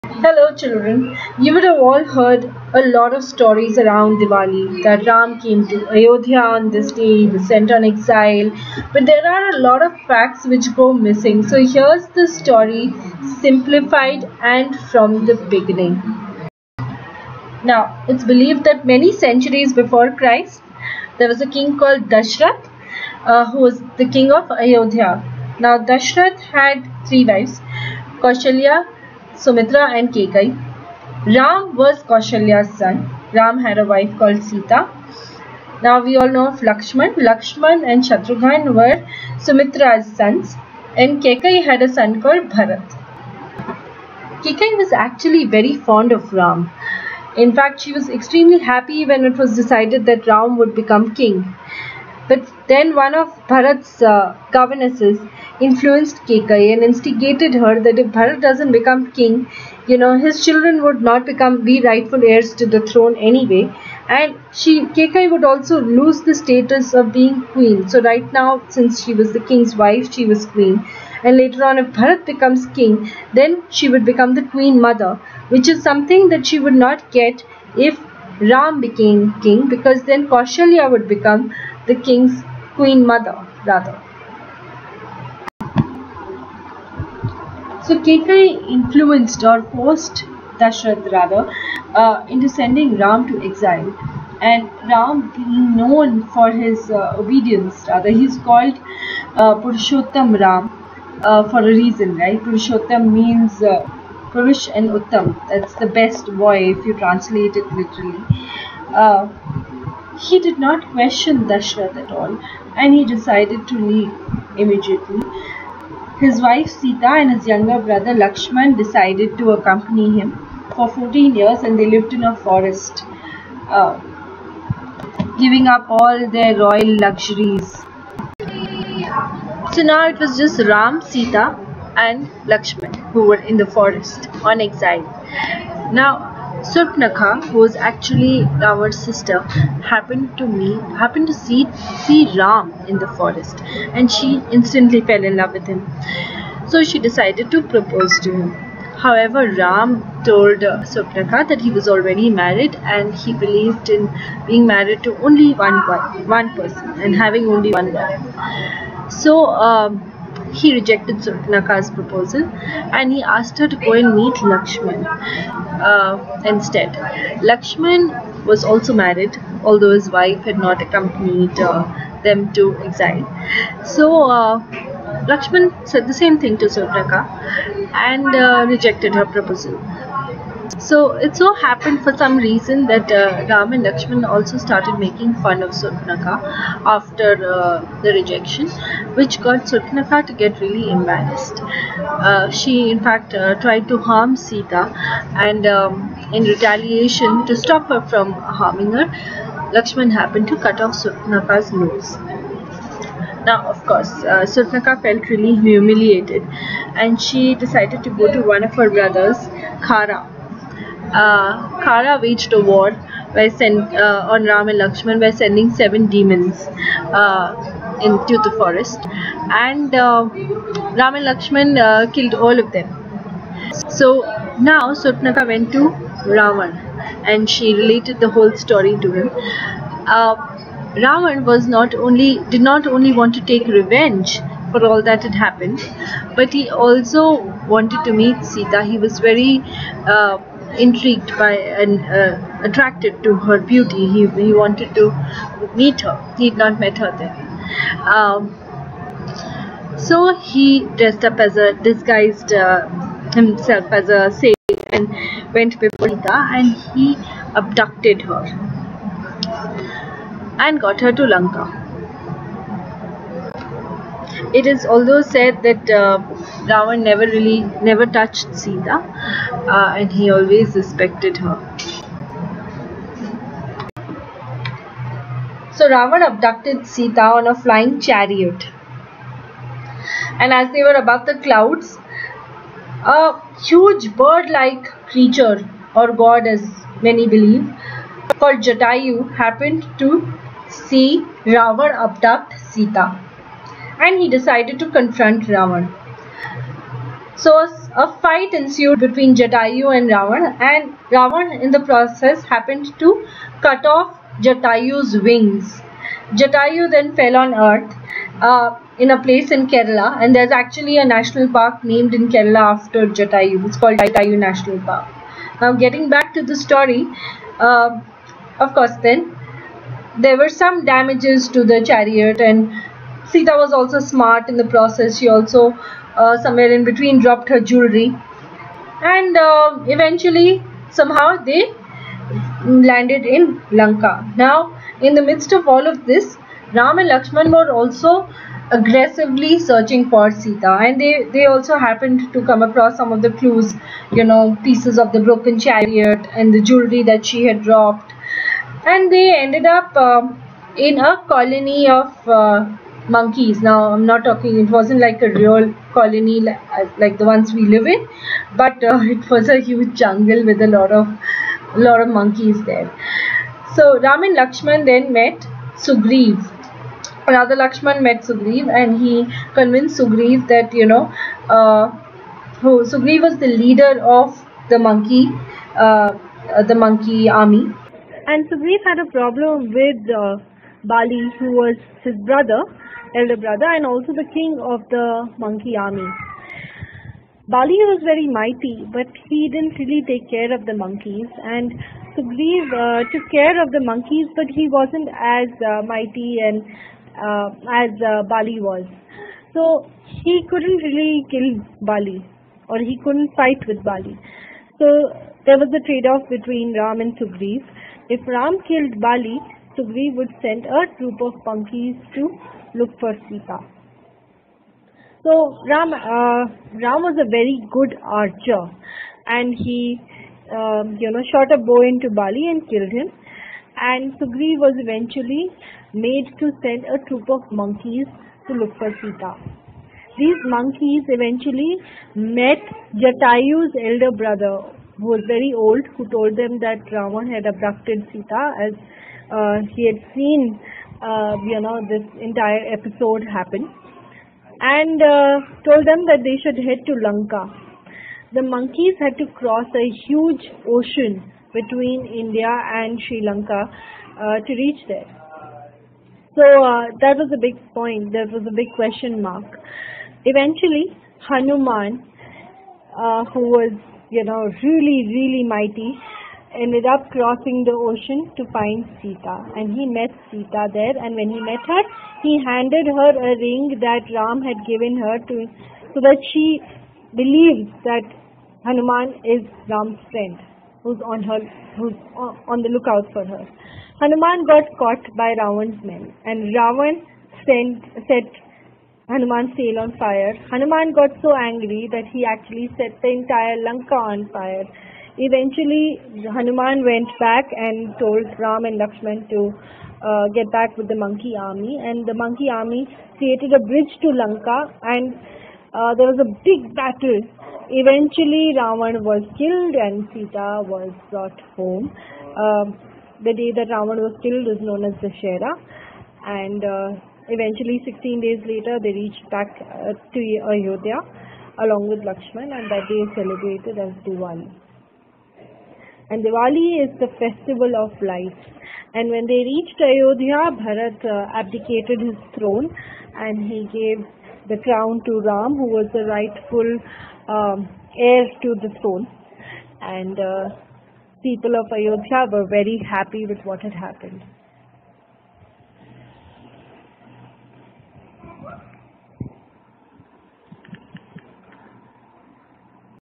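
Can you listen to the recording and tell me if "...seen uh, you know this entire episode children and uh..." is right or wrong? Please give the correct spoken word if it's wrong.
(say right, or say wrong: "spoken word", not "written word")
wrong: "happen", not "children".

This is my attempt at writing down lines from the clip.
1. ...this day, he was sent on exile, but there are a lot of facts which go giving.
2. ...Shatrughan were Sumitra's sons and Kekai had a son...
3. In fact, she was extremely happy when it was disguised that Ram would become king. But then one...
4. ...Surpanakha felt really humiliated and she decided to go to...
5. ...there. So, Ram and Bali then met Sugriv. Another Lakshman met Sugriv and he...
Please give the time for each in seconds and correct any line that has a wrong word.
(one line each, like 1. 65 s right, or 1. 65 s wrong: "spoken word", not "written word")
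1. 6 s wrong: "missing", not "giving"
2. 38 s right
3. 47 s wrong: "decided", not "disguised"
4. 204 s right
5. 362 s wrong: "Lakshman", not "Bali".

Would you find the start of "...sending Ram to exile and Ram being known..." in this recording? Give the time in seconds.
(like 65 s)
92 s.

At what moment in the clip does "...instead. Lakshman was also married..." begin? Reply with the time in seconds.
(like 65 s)
166 s.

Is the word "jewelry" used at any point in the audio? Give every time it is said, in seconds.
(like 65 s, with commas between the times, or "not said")
327 s, 346 s.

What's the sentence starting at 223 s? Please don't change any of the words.
So now Surpanakha went to Ravan and she related the whole story to him.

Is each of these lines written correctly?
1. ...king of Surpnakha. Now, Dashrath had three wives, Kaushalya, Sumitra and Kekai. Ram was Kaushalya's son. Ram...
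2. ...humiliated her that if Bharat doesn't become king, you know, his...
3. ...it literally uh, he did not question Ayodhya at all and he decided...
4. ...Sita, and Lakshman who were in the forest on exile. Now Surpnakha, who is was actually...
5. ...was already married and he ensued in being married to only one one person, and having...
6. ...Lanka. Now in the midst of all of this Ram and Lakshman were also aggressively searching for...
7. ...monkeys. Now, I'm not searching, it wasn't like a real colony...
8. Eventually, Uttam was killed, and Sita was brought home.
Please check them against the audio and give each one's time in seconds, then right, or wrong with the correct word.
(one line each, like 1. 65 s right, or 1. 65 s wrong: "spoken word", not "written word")
1. 24 s wrong: "Ayodhya", not "Surpnakha"
2. 56 s wrong: "instigated", not "humiliated"
3. 107 s wrong: "Dashrath", not "Ayodhya"
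4. 131 s right
5. 151 s wrong: "believed", not "ensued"
6. 333 s right
7. 353 s wrong: "talking", not "searching"
8. 507 s wrong: "Ravan", not "Uttam".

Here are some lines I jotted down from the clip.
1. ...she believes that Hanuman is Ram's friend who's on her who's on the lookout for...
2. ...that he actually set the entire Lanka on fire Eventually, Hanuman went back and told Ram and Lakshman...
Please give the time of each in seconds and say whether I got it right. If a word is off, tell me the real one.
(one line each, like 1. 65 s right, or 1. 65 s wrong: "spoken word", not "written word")
1. 476 s right
2. 491 s right.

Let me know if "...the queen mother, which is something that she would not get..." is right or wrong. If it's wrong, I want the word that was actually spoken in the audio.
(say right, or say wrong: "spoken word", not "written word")
right.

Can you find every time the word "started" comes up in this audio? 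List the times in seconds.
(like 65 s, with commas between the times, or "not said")
184 s.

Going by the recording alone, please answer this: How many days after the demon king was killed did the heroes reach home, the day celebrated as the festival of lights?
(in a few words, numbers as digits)
16.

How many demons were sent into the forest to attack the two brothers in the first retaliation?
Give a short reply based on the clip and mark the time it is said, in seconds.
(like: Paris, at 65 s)
7, at 215 s.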